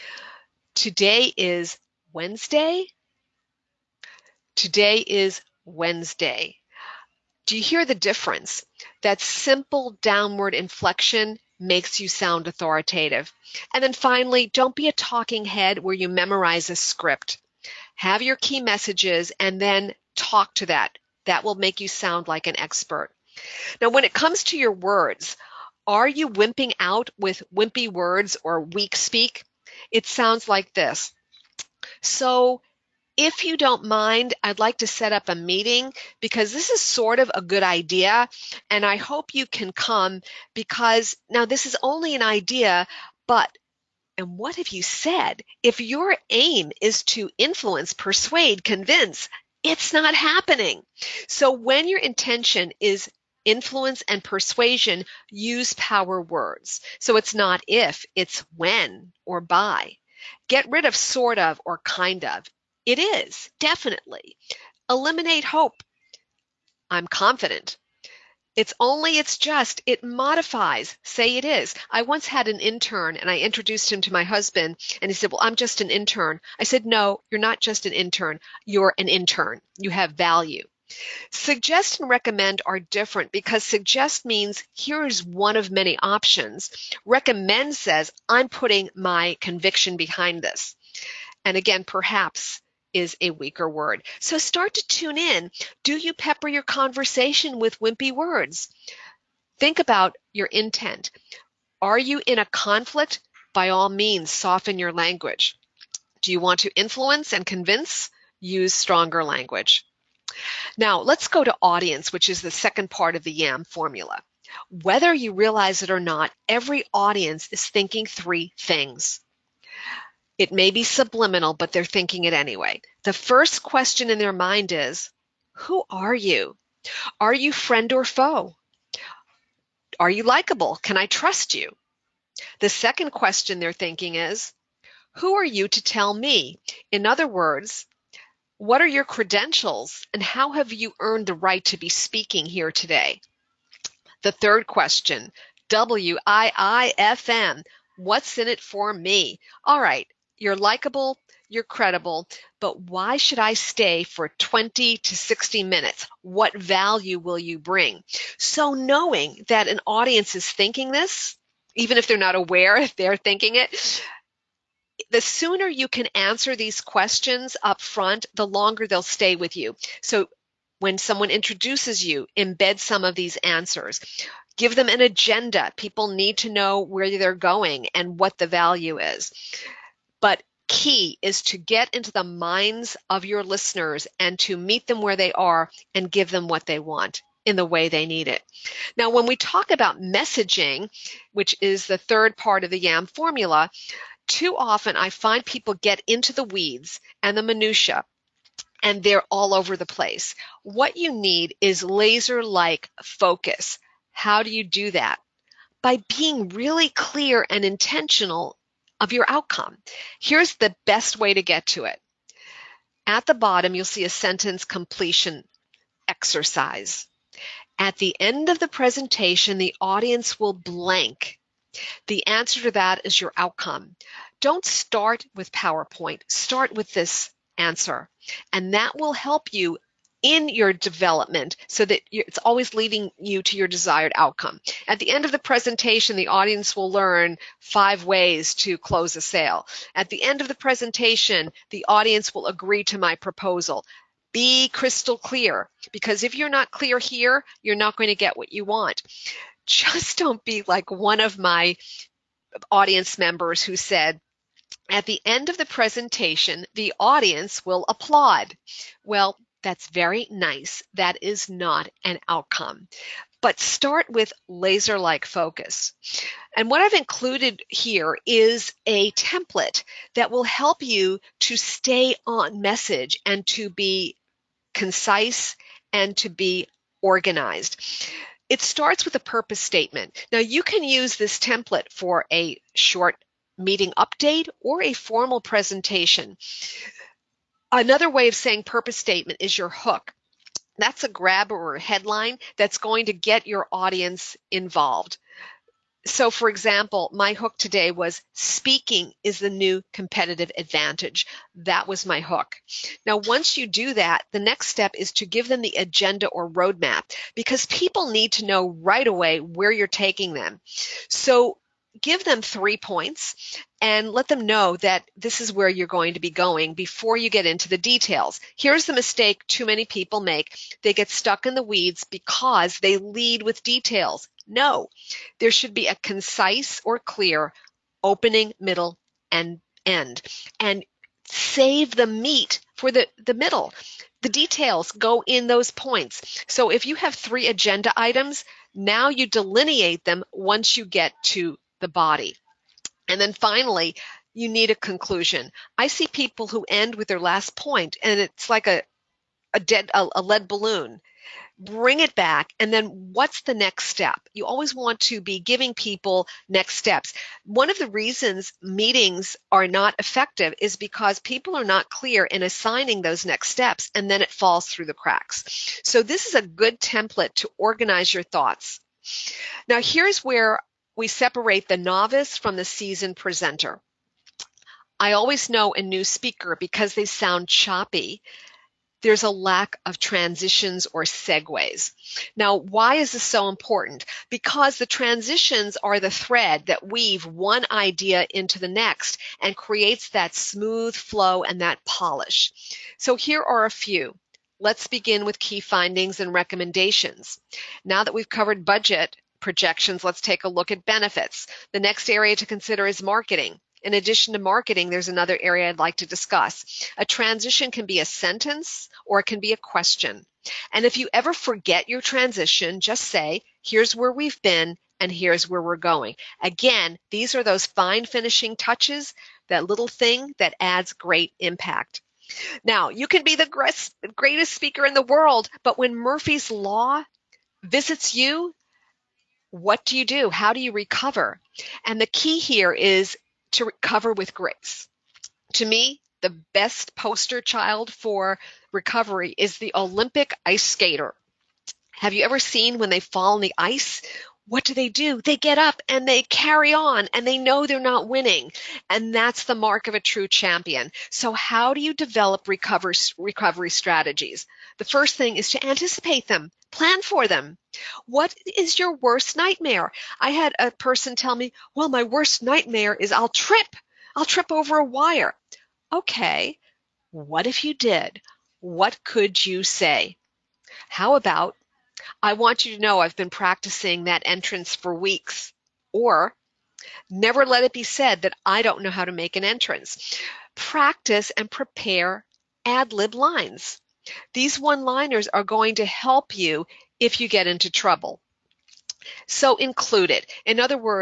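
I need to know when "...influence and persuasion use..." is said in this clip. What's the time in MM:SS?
00:53.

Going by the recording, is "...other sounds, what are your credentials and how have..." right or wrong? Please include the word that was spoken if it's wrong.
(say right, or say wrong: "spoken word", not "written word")
wrong: "words", not "sounds".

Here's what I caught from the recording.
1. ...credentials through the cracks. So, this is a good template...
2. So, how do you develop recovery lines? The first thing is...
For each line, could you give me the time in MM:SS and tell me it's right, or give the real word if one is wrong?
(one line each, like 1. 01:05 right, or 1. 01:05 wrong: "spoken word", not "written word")
1. 06:04 wrong: "falls", not "credentials"
2. 07:31 wrong: "strategies", not "lines".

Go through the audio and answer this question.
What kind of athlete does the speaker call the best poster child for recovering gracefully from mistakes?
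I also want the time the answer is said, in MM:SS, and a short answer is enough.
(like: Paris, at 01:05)
Olympic ice skater, at 07:19.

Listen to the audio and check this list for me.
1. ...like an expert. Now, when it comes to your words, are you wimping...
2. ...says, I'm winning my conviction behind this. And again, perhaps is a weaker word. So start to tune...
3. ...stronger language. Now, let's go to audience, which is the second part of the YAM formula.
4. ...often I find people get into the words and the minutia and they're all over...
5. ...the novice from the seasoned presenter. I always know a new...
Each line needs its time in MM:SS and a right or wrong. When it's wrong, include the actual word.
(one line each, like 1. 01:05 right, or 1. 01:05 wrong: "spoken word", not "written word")
1. 00:22 right
2. 01:27 wrong: "putting", not "winning"
3. 01:48 right
4. 03:14 wrong: "weeds", not "words"
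5. 06:11 right.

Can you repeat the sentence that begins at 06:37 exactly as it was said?
Now that we've covered budget, projections, let's take a look at benefits.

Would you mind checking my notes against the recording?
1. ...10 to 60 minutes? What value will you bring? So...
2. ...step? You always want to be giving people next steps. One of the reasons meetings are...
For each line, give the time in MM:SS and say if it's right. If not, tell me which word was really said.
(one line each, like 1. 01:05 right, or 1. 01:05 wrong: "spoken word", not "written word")
1. 02:34 wrong: "20", not "10"
2. 05:53 right.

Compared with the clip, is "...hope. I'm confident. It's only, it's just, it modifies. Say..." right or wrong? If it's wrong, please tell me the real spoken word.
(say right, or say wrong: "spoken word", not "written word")
right.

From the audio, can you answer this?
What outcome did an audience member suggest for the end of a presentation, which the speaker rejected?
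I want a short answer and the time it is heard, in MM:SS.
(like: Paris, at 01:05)
applaud, at 04:17.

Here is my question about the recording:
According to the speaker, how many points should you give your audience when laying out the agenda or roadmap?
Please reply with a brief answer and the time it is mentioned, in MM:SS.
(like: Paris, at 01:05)
3, at 05:12.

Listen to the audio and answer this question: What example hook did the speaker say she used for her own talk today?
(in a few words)
speaking is the new competitive advantage.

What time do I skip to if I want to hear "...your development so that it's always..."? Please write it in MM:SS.
03:50.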